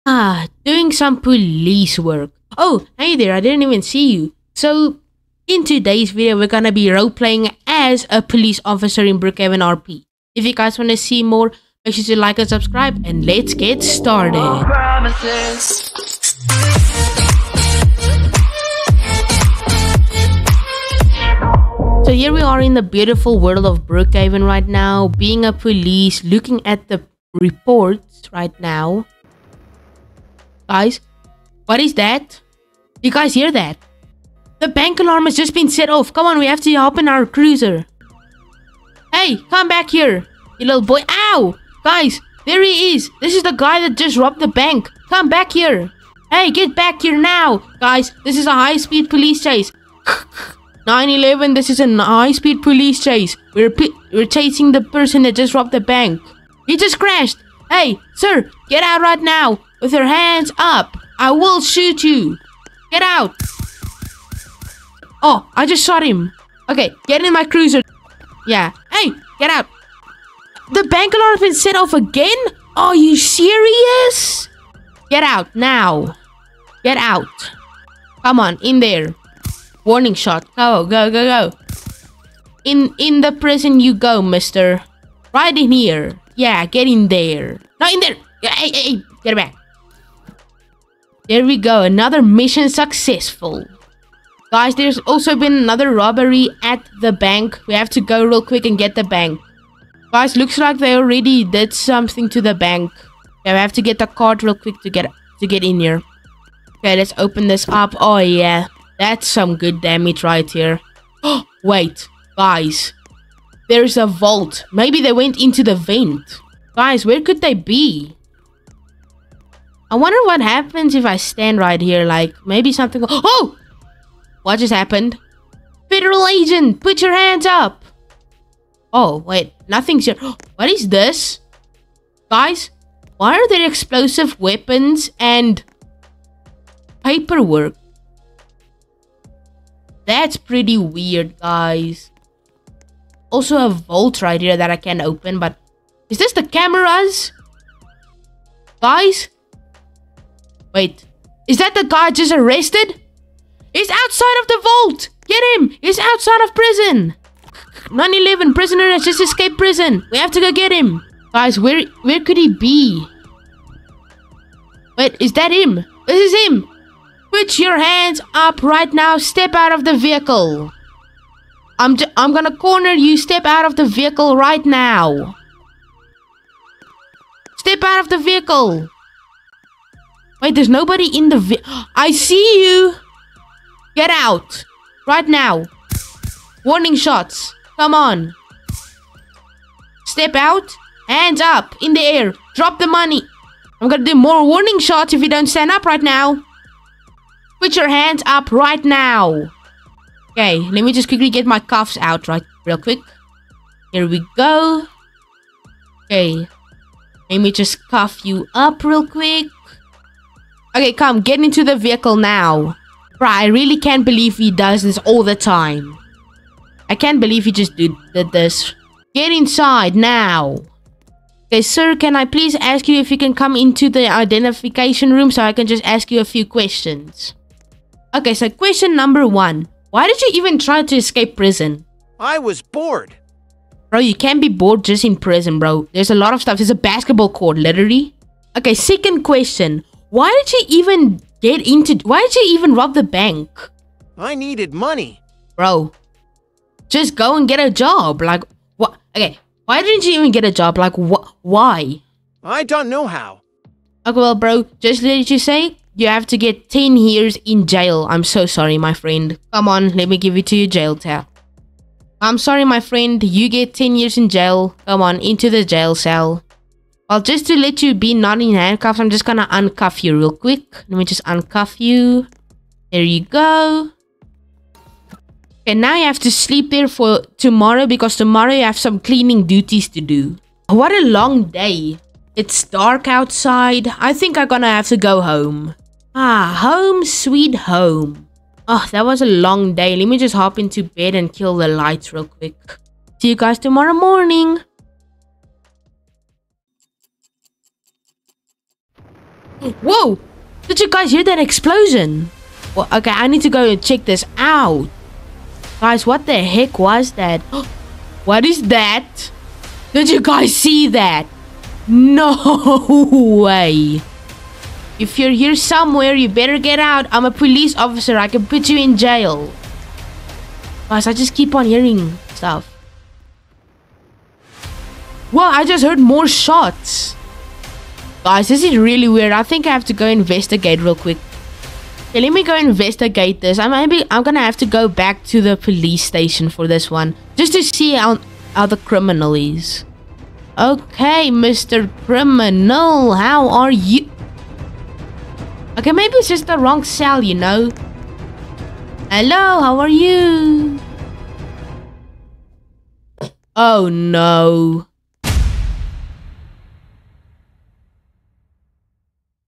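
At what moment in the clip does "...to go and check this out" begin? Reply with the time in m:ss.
5:03.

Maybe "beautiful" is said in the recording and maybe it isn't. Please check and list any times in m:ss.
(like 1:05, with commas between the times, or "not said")
0:22.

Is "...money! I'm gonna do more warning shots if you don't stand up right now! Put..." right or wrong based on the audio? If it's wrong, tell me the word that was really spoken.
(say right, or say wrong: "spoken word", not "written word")
right.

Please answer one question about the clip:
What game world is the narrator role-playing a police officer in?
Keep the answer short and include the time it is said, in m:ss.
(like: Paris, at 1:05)
Brookhaven RP, at 0:09.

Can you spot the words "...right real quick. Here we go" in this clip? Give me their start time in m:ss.
3:22.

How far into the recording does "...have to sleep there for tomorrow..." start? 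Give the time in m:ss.
4:36.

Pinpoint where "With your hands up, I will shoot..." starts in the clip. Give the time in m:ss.
0:59.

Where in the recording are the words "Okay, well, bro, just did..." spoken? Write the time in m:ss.
4:14.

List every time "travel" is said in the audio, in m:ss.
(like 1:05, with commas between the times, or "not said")
not said.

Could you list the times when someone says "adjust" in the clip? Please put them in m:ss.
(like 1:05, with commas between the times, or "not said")
not said.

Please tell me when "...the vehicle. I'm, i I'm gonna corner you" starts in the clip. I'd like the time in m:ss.
2:49.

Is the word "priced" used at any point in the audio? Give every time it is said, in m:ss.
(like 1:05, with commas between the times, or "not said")
not said.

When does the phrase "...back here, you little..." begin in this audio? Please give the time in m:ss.
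0:39.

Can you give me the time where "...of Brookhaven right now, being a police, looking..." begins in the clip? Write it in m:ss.
0:23.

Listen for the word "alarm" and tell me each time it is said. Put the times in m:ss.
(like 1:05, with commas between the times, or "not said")
0:35, 1:11.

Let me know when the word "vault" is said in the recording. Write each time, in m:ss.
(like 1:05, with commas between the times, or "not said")
1:54, 2:23, 2:34.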